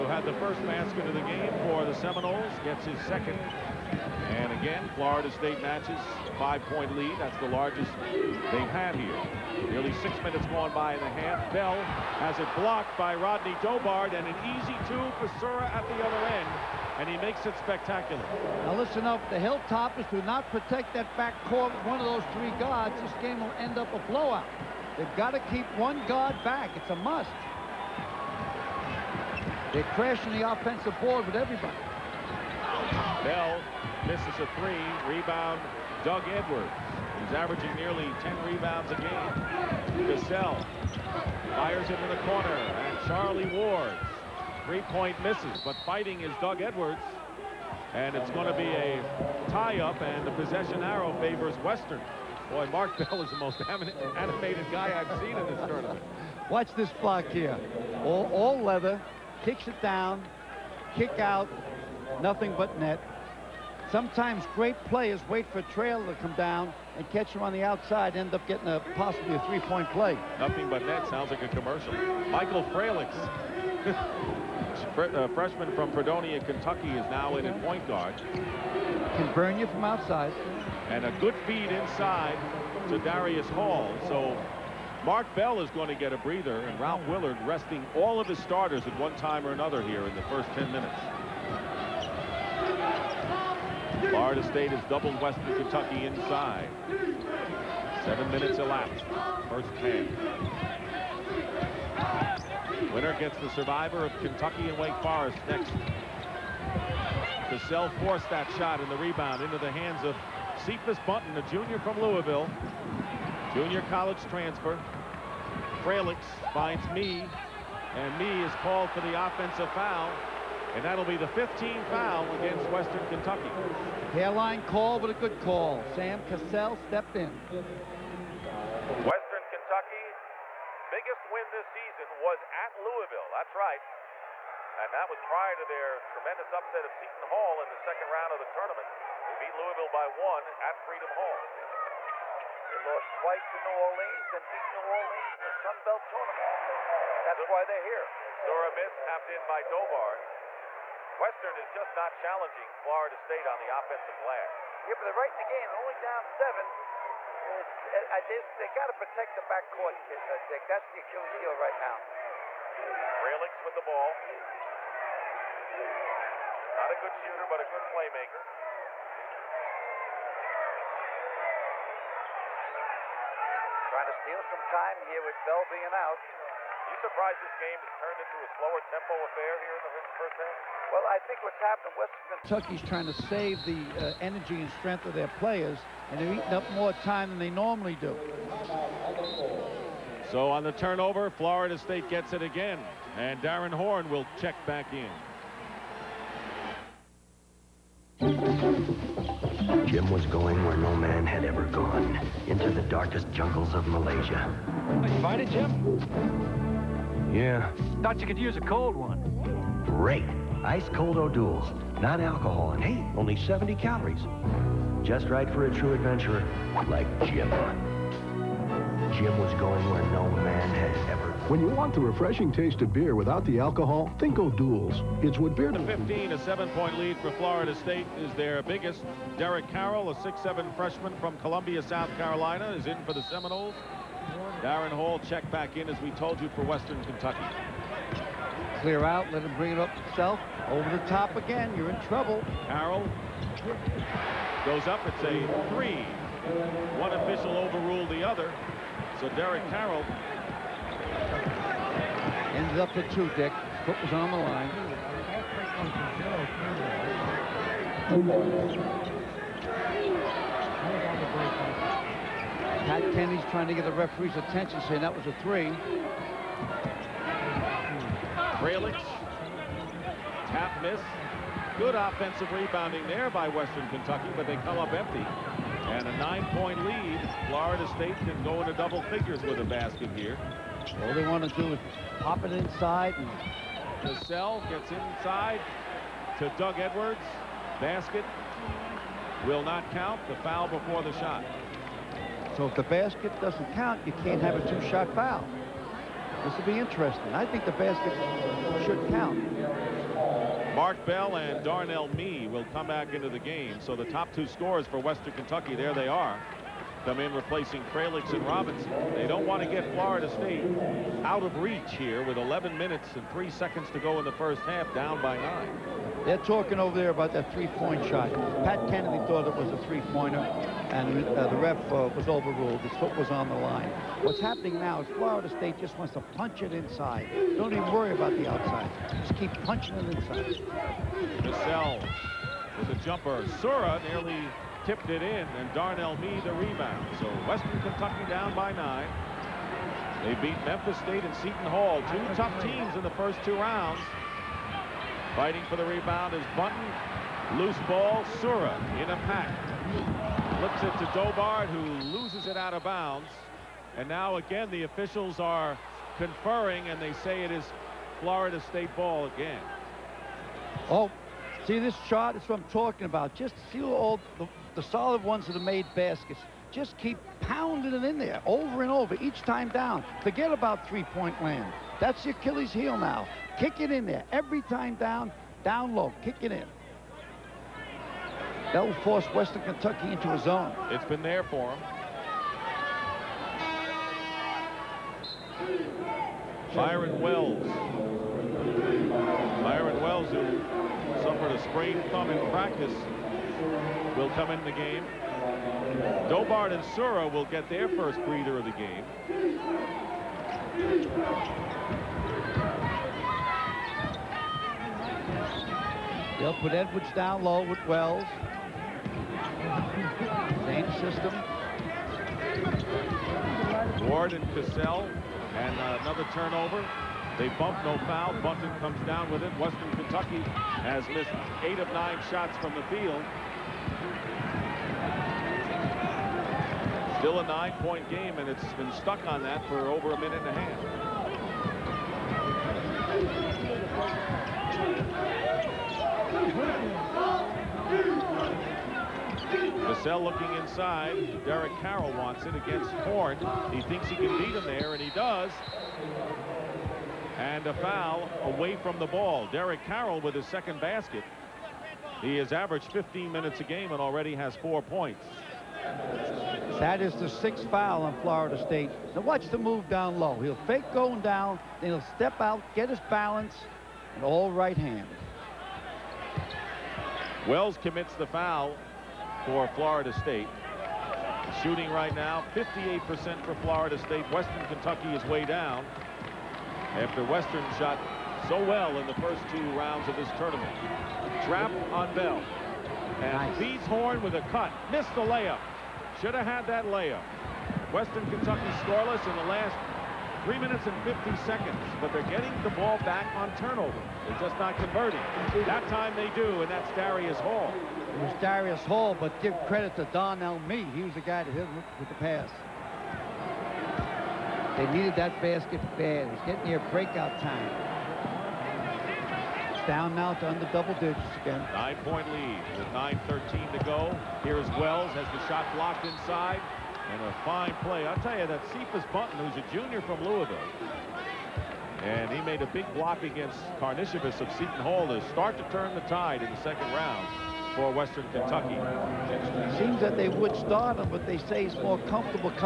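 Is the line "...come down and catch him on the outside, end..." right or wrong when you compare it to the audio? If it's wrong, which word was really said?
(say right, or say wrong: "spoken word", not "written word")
right.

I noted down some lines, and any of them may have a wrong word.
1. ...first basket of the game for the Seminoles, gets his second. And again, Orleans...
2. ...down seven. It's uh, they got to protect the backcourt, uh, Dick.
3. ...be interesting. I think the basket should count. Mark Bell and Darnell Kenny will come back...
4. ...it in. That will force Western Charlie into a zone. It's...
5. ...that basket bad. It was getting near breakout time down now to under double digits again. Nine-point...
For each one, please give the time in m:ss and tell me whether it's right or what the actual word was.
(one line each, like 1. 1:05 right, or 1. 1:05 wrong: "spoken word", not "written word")
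1. 0:00 wrong: "Florida", not "Orleans"
2. 2:35 right
3. 4:56 wrong: "Mee", not "Kenny"
4. 6:16 wrong: "Kentucky", not "Charlie"
5. 8:25 right.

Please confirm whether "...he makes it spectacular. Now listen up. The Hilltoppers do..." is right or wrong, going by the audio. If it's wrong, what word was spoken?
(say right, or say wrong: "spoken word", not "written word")
right.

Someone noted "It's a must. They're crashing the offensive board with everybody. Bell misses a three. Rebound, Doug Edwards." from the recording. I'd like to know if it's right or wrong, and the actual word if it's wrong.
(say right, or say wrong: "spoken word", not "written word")
right.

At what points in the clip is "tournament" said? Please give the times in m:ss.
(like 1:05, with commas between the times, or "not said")
0:55, 2:18, 2:26, 8:00.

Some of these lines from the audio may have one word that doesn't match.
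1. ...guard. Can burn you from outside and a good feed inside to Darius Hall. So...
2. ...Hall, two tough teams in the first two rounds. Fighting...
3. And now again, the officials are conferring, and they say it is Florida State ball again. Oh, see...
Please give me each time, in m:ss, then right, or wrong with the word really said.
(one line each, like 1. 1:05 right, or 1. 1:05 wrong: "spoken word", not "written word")
1. 1:17 right
2. 5:41 right
3. 5:53 right.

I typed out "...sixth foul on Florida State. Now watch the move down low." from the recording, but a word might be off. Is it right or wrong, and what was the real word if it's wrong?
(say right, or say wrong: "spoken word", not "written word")
right.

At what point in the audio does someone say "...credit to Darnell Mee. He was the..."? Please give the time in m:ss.
8:19.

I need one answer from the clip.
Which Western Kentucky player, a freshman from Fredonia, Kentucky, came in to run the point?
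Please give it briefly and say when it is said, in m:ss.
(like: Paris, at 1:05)
Michael Fralix, at 1:12.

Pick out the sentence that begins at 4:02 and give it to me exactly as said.
Carroll goes up, it's a three.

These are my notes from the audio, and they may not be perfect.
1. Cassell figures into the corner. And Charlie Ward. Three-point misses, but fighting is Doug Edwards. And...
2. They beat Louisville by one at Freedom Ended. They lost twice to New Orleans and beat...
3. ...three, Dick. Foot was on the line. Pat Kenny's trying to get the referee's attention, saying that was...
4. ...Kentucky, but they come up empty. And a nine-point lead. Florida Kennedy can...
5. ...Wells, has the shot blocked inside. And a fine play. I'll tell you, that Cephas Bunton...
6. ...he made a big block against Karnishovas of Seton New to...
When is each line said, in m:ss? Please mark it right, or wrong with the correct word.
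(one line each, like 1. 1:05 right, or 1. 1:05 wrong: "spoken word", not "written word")
1. 0:40 wrong: "fires", not "figures"
2. 2:19 wrong: "Hall", not "Ended"
3. 4:13 wrong: "two", not "three"
4. 4:33 wrong: "State", not "Kennedy"
5. 8:34 right
6. 8:42 wrong: "Hall", not "New".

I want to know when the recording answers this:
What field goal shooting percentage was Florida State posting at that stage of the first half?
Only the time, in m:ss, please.
7:52.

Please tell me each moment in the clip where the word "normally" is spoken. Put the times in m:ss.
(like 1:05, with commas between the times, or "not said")
3:07.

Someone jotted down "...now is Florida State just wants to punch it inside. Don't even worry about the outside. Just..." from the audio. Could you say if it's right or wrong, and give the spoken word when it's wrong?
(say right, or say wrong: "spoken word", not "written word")
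right.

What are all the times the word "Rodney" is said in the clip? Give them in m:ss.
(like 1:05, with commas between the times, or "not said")
0:13.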